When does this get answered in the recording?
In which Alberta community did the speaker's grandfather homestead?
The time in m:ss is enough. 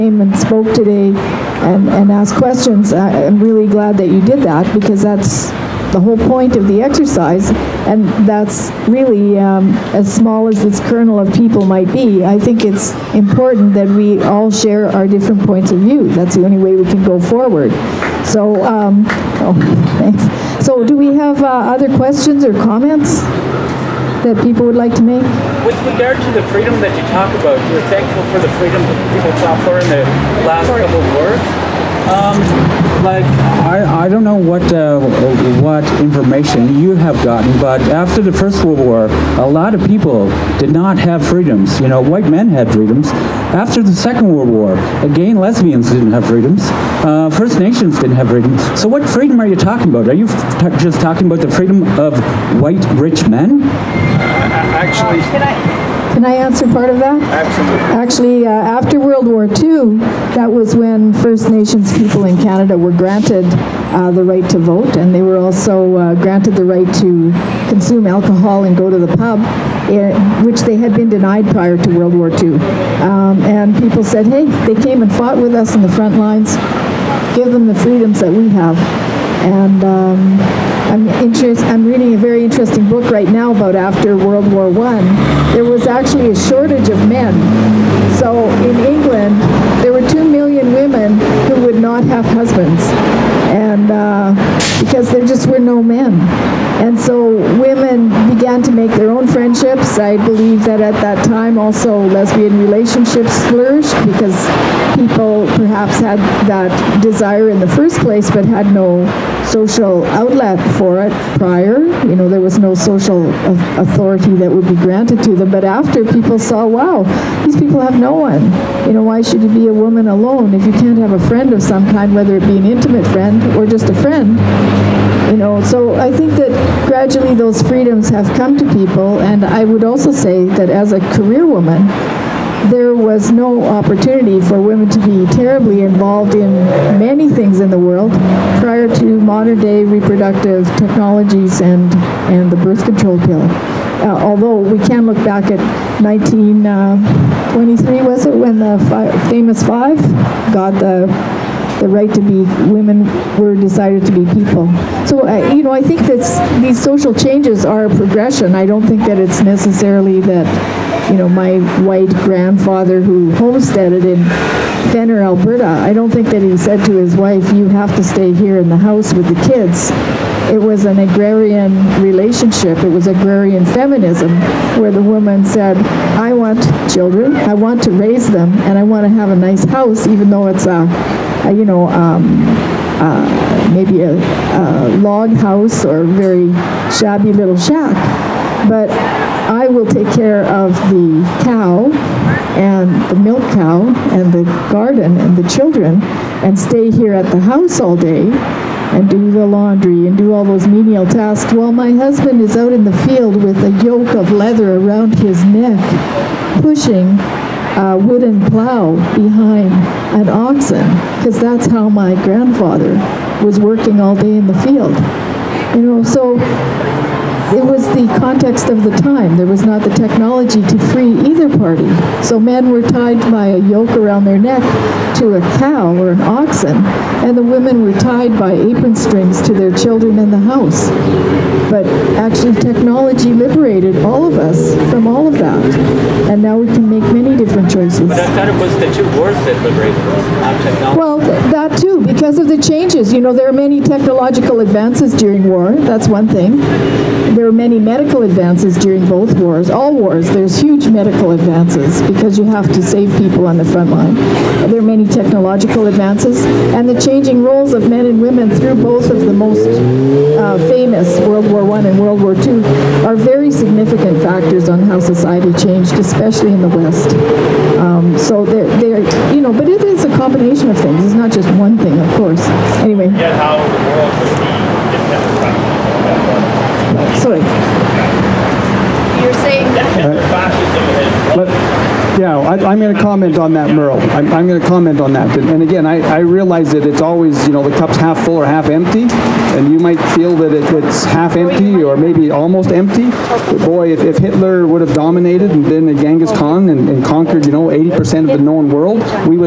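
2:44.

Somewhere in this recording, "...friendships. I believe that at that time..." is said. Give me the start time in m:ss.
1:39.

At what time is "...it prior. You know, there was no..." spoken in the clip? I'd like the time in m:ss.
1:51.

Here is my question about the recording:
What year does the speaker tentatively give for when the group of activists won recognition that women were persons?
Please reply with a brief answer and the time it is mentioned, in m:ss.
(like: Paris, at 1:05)
1923, at 2:26.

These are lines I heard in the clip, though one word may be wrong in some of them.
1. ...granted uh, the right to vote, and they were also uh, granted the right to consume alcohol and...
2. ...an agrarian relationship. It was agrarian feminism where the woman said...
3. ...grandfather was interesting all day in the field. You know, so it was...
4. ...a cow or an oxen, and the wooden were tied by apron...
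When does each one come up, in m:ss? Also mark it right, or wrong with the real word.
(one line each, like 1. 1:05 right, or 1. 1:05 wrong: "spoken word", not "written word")
1. 1:02 right
2. 2:50 right
3. 3:32 wrong: "working", not "interesting"
4. 3:45 wrong: "women", not "wooden".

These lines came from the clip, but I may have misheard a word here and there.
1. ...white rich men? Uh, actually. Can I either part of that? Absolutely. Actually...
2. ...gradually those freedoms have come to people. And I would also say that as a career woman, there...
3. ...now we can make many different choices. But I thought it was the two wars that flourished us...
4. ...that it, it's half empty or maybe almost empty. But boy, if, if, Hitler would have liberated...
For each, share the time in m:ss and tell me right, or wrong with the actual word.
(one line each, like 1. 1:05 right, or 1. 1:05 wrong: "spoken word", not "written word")
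1. 0:52 wrong: "answer", not "either"
2. 2:06 right
3. 3:56 wrong: "liberated", not "flourished"
4. 4:50 wrong: "dominated", not "liberated".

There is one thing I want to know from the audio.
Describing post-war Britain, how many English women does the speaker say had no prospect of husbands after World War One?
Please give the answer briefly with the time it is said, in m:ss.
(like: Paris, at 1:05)
2 million, at 1:30.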